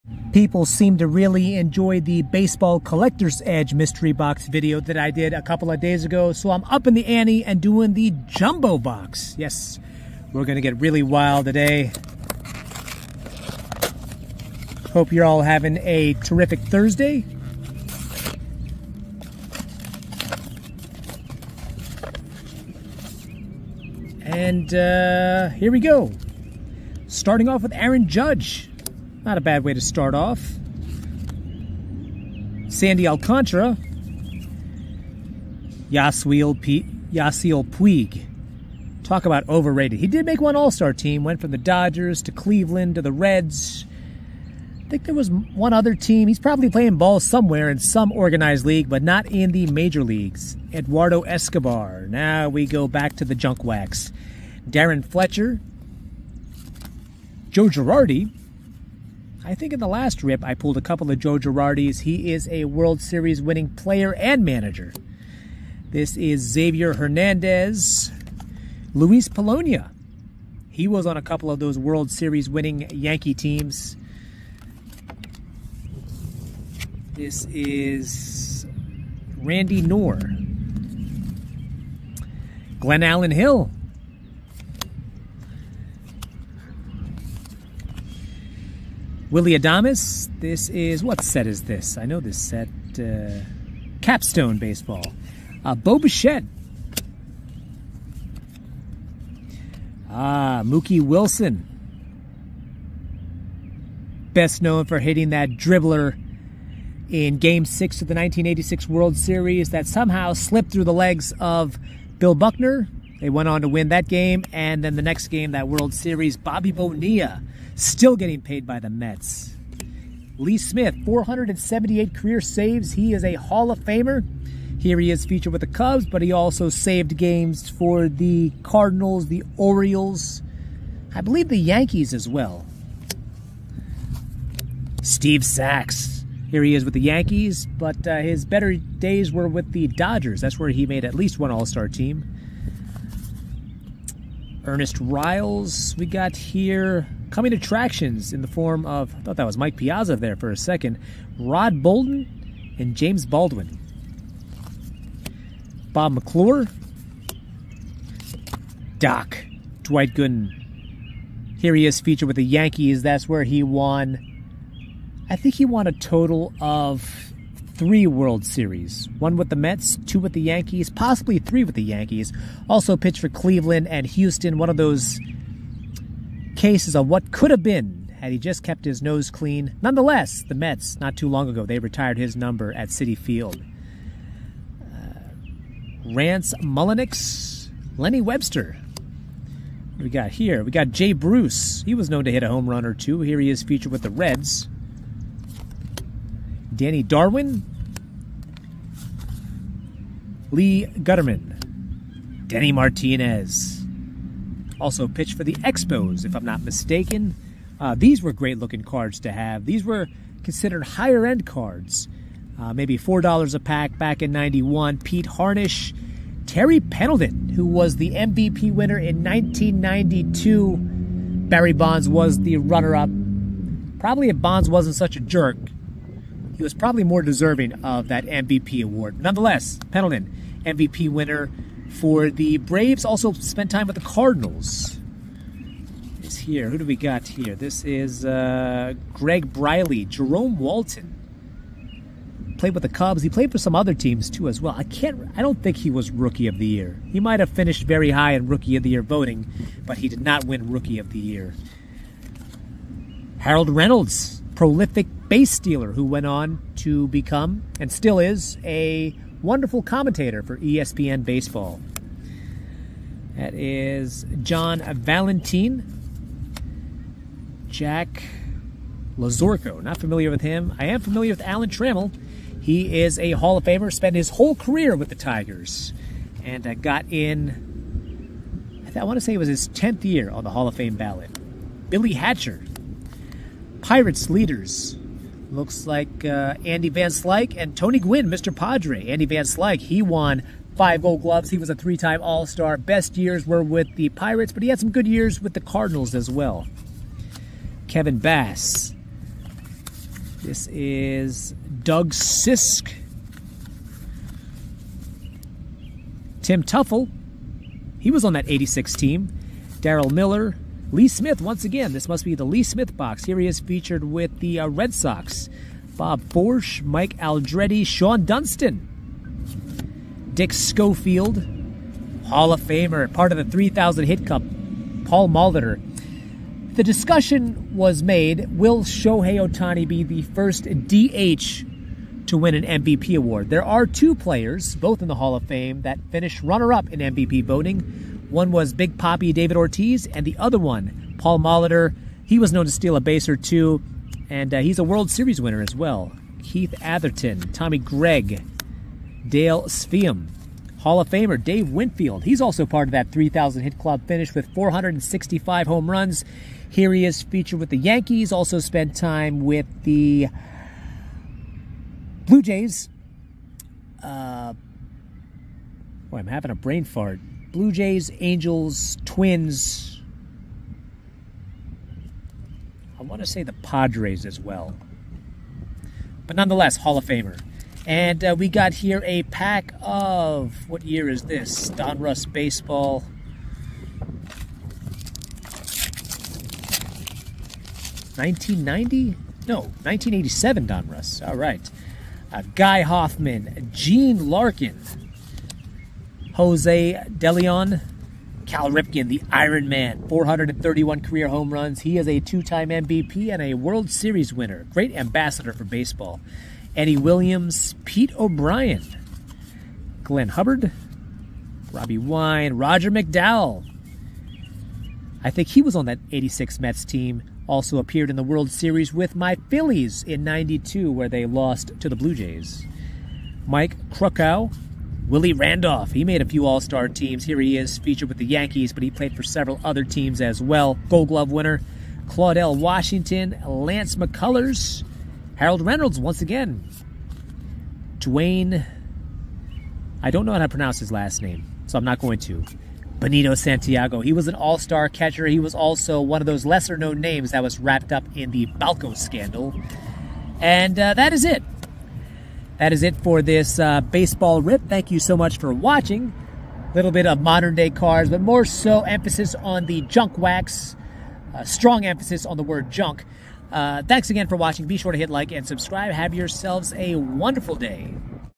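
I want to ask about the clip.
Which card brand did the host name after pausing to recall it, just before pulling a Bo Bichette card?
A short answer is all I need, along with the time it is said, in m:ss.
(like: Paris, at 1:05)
Capstone Baseball, at 1:34.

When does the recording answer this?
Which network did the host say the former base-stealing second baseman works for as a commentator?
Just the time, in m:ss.
4:20.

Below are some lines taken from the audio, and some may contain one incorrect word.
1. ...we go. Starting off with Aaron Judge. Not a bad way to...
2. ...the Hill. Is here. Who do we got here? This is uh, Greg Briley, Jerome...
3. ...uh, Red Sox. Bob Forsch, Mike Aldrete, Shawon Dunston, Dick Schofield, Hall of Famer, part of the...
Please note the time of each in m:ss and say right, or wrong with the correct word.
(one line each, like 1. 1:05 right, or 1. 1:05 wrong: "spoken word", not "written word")
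1. 0:25 right
2. 3:53 wrong: "Cardinals", not "Hill"
3. 5:14 right.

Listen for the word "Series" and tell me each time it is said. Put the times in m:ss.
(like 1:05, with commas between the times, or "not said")
1:03, 1:12, 1:49, 1:55, 2:48, 5:45, 6:43, 6:58.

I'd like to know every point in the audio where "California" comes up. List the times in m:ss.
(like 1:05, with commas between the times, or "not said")
not said.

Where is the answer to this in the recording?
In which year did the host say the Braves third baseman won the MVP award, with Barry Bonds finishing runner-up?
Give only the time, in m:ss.
3:39.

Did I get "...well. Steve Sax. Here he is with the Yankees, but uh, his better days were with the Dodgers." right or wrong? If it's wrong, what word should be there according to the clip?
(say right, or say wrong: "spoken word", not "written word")
right.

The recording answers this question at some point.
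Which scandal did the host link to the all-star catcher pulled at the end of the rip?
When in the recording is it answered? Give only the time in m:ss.
7:28.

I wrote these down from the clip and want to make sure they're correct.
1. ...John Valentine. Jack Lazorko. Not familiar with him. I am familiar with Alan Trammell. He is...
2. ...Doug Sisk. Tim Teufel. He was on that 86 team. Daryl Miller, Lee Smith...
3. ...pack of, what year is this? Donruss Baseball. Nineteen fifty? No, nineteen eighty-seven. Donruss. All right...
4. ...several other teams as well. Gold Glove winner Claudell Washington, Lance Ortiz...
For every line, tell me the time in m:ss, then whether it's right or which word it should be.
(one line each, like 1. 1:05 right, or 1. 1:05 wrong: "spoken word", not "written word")
1. 4:24 right
2. 5:01 right
3. 6:19 wrong: "ninety", not "fifty"
4. 7:09 wrong: "McCullers", not "Ortiz".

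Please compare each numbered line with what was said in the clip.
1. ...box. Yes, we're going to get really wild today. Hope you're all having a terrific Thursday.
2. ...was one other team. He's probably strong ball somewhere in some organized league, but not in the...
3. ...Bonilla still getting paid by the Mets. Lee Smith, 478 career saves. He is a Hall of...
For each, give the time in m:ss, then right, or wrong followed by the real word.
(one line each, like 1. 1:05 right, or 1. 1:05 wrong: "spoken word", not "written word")
1. 0:08 right
2. 0:45 wrong: "playing", not "strong"
3. 1:56 right.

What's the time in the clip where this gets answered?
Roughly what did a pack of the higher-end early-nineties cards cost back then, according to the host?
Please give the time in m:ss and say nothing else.
3:32.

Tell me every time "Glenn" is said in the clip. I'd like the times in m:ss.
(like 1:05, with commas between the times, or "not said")
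1:22, 6:50.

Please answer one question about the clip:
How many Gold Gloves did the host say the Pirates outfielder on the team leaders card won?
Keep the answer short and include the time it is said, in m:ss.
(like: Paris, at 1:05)
5, at 4:50.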